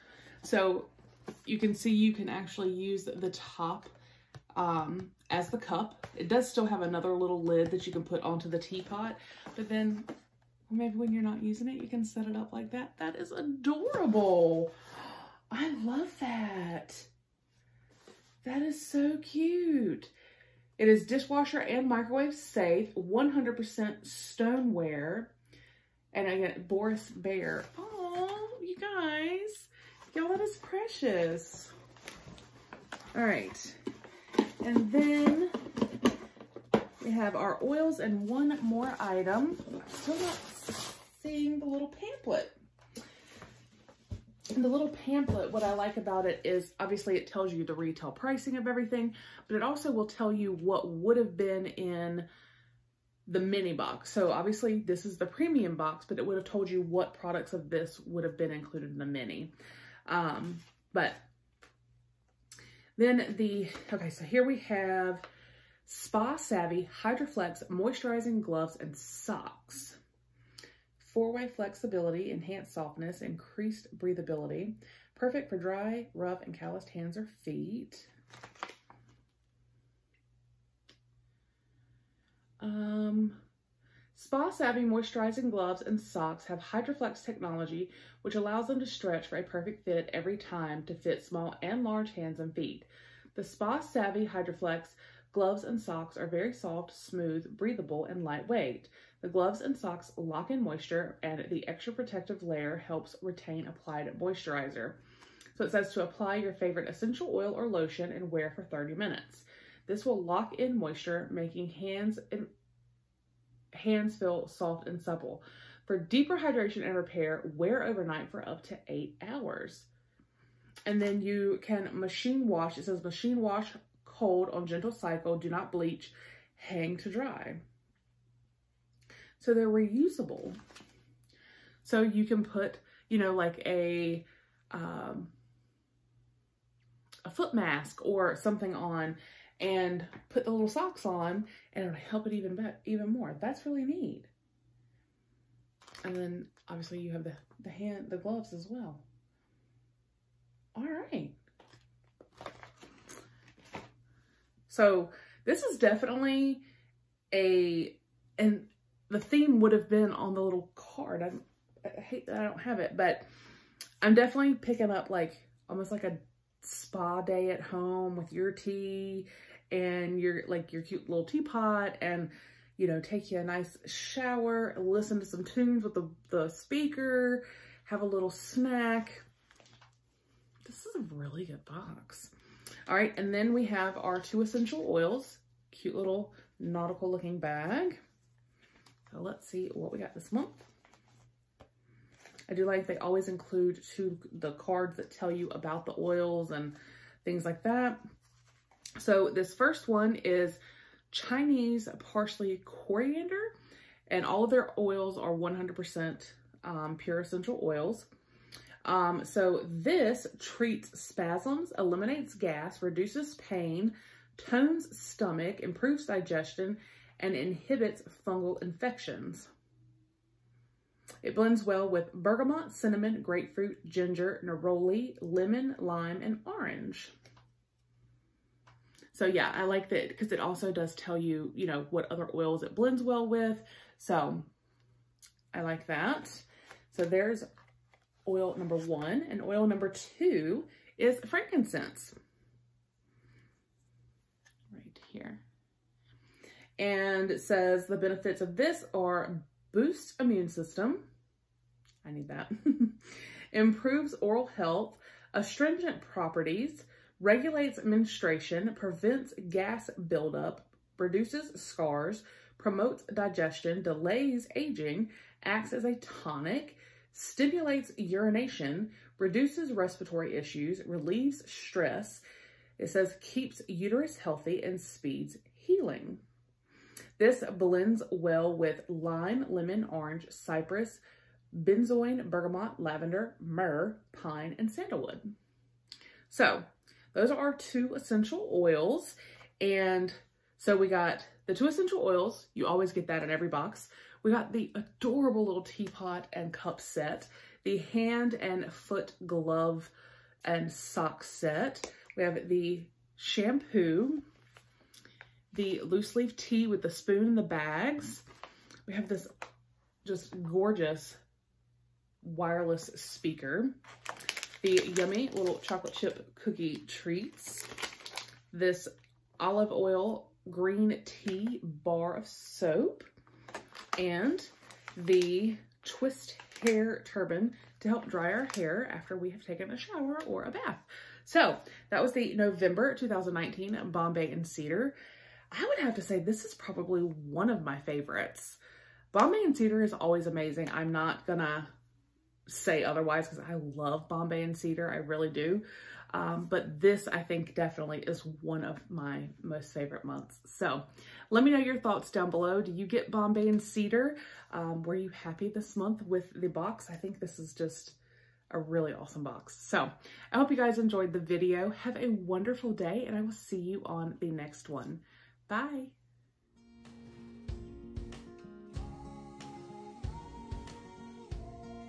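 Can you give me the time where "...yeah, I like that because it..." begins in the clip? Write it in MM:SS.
03:49.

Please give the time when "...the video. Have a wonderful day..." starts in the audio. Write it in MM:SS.
06:01.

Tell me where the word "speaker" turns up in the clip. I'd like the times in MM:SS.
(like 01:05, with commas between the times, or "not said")
02:56, 05:12.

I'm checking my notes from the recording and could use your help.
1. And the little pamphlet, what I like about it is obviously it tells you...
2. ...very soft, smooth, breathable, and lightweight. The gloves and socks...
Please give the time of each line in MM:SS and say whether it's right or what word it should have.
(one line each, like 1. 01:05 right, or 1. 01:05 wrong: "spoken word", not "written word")
1. 00:44 right
2. 01:36 right.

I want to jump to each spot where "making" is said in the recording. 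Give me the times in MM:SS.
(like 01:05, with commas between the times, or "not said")
01:51.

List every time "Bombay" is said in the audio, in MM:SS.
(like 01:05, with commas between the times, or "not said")
05:33, 05:39, 05:44, 05:53.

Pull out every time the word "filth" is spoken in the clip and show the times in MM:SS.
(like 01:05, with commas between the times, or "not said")
not said.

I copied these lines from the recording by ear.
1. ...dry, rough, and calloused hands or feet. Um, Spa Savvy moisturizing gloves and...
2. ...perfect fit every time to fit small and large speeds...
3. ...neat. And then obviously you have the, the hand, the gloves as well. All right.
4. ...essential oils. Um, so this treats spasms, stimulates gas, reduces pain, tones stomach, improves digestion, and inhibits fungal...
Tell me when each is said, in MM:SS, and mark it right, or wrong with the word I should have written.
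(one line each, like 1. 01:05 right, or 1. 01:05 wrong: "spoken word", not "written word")
1. 01:15 right
2. 01:29 wrong: "hands", not "speeds"
3. 02:23 right
4. 03:27 wrong: "eliminates", not "stimulates".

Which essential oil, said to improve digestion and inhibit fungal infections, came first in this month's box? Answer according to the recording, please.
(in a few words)
Chinese parsley coriander.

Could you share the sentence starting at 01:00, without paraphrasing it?
Um, but then the, okay, so here we have Spa Savvy Hydroflex Moisturizing Gloves and Socks.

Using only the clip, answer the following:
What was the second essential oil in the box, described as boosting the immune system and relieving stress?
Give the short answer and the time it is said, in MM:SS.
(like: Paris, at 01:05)
Frankincense, at 04:01.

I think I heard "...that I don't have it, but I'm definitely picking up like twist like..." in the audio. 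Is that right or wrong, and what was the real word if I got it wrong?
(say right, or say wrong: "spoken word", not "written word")
wrong: "almost", not "twist".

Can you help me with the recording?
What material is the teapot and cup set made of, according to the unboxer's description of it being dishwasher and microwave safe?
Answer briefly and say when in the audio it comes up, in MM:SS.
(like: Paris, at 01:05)
100% stoneware, at 00:22.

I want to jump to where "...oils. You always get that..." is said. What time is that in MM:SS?
04:51.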